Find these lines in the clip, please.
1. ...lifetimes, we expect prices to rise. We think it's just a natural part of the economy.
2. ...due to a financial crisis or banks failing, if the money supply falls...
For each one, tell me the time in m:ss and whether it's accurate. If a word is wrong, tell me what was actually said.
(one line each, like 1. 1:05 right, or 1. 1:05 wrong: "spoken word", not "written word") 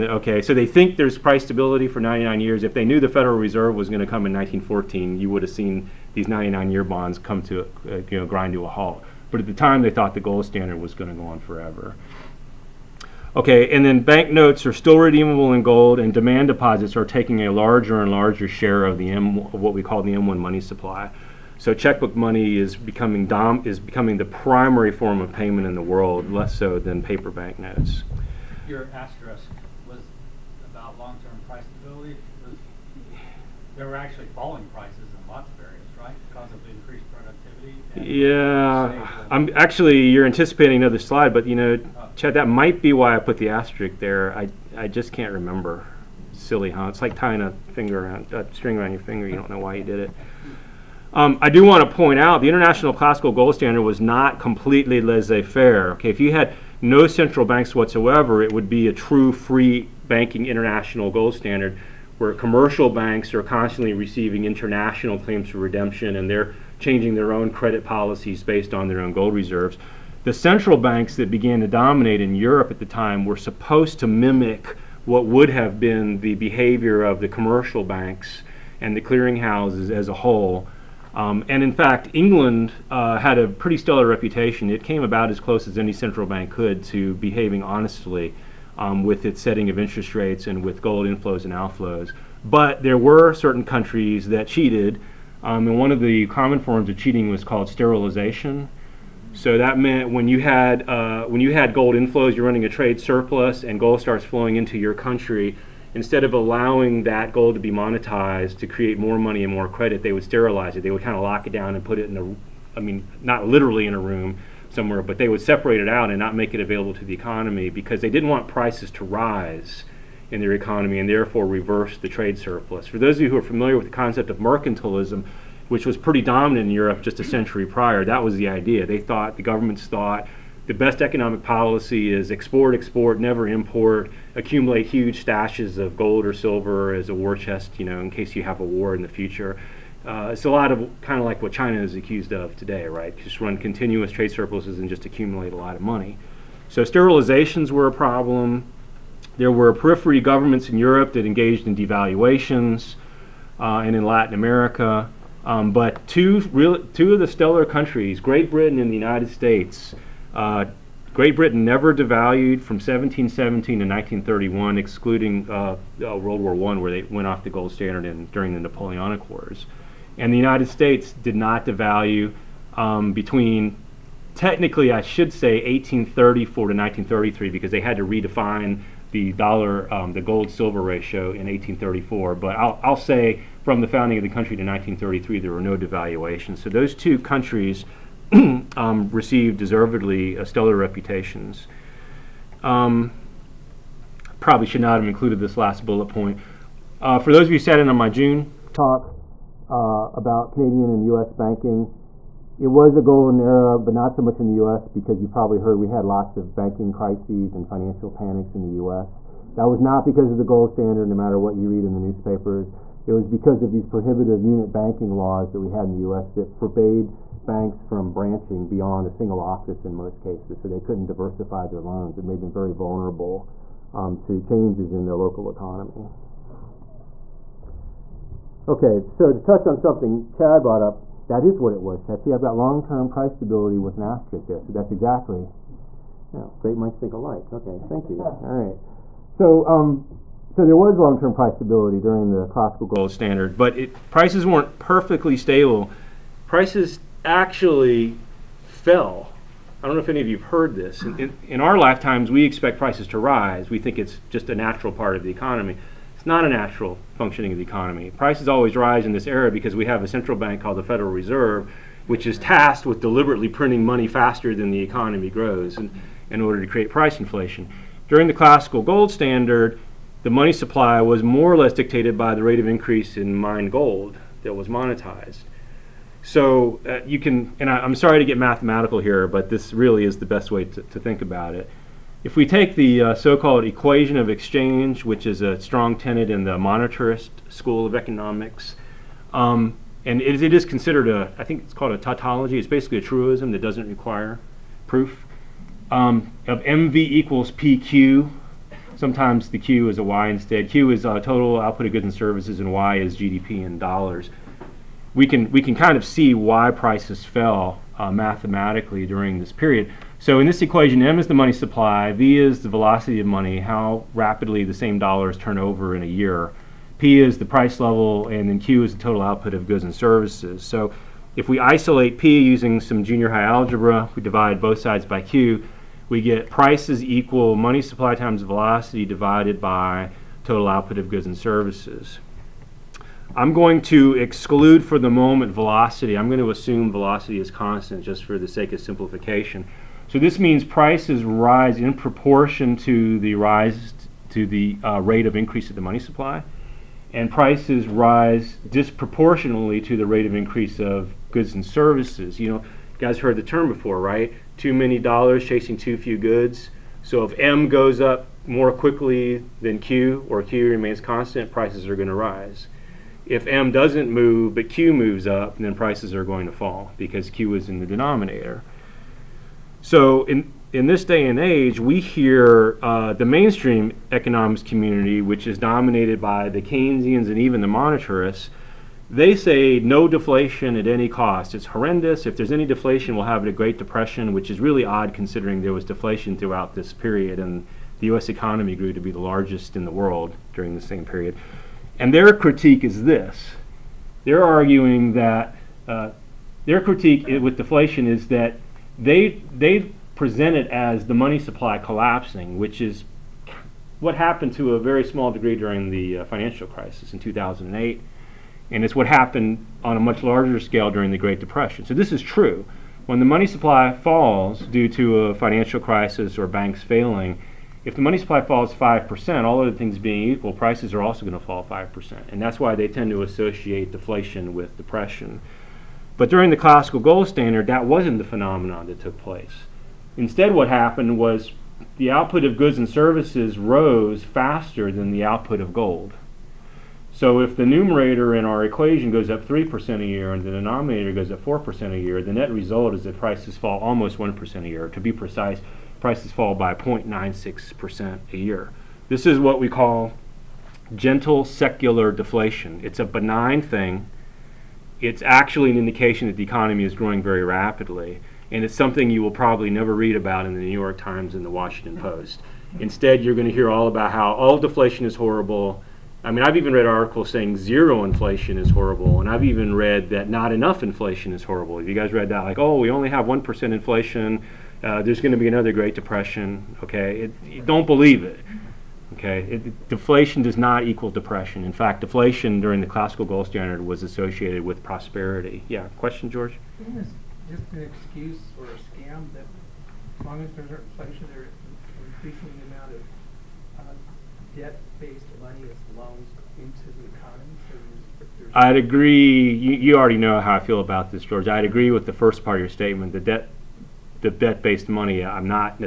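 1. 4:11 right
2. 6:54 right.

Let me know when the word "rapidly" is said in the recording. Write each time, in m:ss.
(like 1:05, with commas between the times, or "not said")
5:14, 7:37.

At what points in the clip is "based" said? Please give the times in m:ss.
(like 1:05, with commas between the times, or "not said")
1:08, 8:14, 8:24.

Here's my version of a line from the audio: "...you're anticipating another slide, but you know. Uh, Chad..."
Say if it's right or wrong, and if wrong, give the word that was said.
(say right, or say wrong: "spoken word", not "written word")
right.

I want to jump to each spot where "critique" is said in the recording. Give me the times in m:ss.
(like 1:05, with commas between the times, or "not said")
6:32, 6:36.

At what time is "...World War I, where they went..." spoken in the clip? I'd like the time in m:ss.
2:46.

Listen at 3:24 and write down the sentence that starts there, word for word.
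because you probably heard we had lots of banking crises and financial panics in the U.S.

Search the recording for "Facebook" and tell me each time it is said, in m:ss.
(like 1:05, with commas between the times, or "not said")
not said.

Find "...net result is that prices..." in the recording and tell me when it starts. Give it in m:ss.
7:22.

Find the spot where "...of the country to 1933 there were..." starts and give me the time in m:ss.
3:04.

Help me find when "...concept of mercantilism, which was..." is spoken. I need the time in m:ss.
2:03.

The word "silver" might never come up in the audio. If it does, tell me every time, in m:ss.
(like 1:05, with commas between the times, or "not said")
2:16, 3:00.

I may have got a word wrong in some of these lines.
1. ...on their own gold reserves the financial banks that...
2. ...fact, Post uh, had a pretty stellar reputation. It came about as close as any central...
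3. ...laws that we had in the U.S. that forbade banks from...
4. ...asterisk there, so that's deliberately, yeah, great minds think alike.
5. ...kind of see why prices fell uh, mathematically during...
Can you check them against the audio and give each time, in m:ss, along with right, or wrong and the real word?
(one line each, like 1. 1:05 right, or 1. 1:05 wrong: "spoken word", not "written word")
1. 1:08 wrong: "central", not "financial"
2. 1:21 wrong: "England", not "Post"
3. 3:35 right
4. 3:54 wrong: "exactly", not "deliberately"
5. 5:05 right.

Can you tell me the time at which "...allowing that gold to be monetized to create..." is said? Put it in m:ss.
1:46.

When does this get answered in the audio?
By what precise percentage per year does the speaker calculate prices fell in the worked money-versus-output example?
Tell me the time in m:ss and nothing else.
7:26.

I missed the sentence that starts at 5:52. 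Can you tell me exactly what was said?
You know, you guys heard the term before, right?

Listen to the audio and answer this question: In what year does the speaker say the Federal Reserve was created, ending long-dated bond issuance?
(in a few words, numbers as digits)
1914.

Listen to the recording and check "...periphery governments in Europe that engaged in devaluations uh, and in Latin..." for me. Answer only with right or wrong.
right.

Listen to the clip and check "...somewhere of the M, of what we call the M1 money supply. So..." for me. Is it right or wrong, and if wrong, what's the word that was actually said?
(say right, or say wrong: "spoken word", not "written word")
wrong: "share", not "somewhere".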